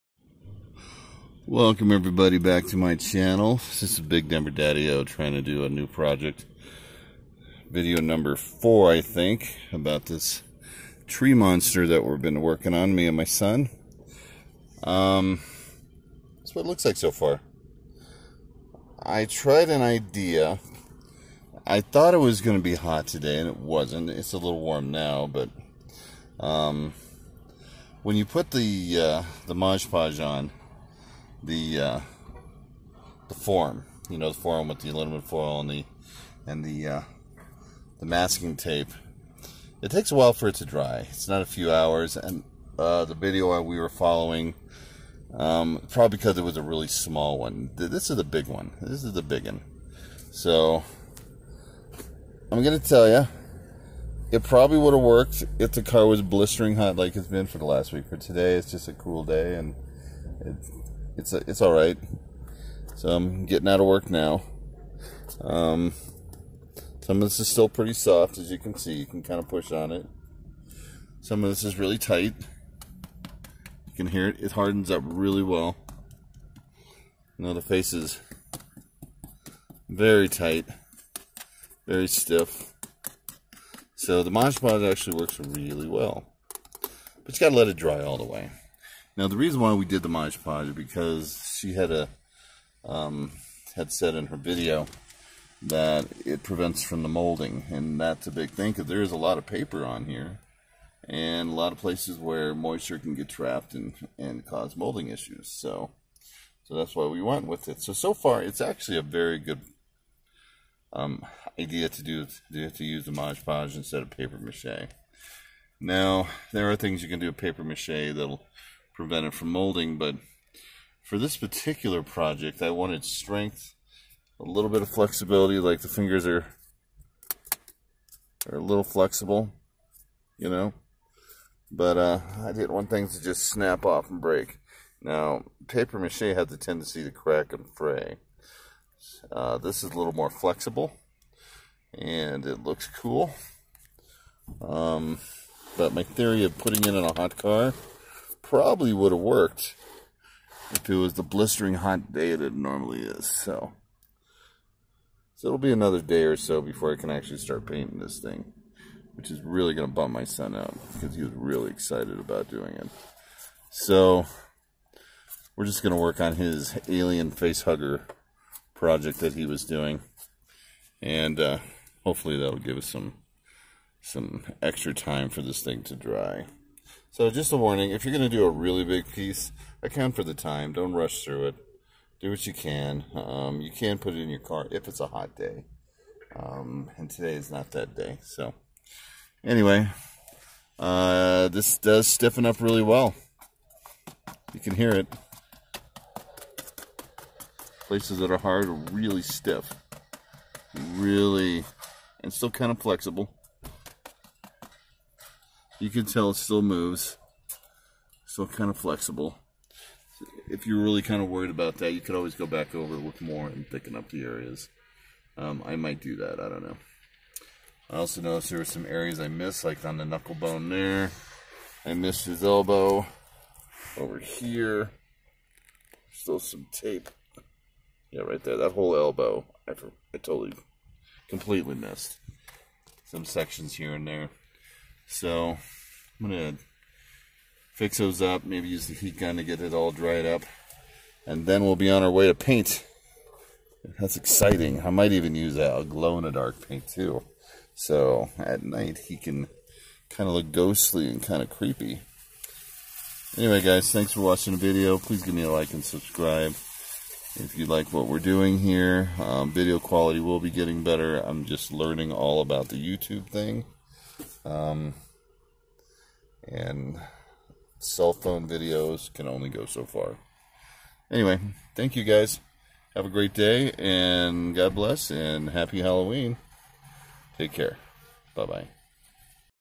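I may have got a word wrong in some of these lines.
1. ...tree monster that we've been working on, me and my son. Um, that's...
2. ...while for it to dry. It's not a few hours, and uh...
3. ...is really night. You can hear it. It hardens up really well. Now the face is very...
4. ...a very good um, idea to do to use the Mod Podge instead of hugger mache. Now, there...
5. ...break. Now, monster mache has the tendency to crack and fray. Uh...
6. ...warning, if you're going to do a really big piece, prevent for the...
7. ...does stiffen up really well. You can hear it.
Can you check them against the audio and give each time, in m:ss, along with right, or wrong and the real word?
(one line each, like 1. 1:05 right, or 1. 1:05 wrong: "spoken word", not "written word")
1. 0:11 right
2. 0:40 right
3. 1:11 wrong: "tight", not "night"
4. 1:48 wrong: "paper", not "hugger"
5. 2:14 wrong: "paper", not "monster"
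6. 2:57 wrong: "account", not "prevent"
7. 3:11 right.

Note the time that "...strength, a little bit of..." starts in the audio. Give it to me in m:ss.
2:03.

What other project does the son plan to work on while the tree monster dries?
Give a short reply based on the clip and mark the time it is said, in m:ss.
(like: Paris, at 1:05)
alien face hugger, at 2:46.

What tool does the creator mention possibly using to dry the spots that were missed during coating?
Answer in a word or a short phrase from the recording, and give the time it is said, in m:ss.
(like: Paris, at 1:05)
heat gun, at 3:58.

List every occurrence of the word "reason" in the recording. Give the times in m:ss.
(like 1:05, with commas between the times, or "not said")
1:29.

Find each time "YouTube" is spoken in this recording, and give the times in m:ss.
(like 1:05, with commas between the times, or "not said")
4:22.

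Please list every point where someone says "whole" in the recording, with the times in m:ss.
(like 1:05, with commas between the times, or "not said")
3:48.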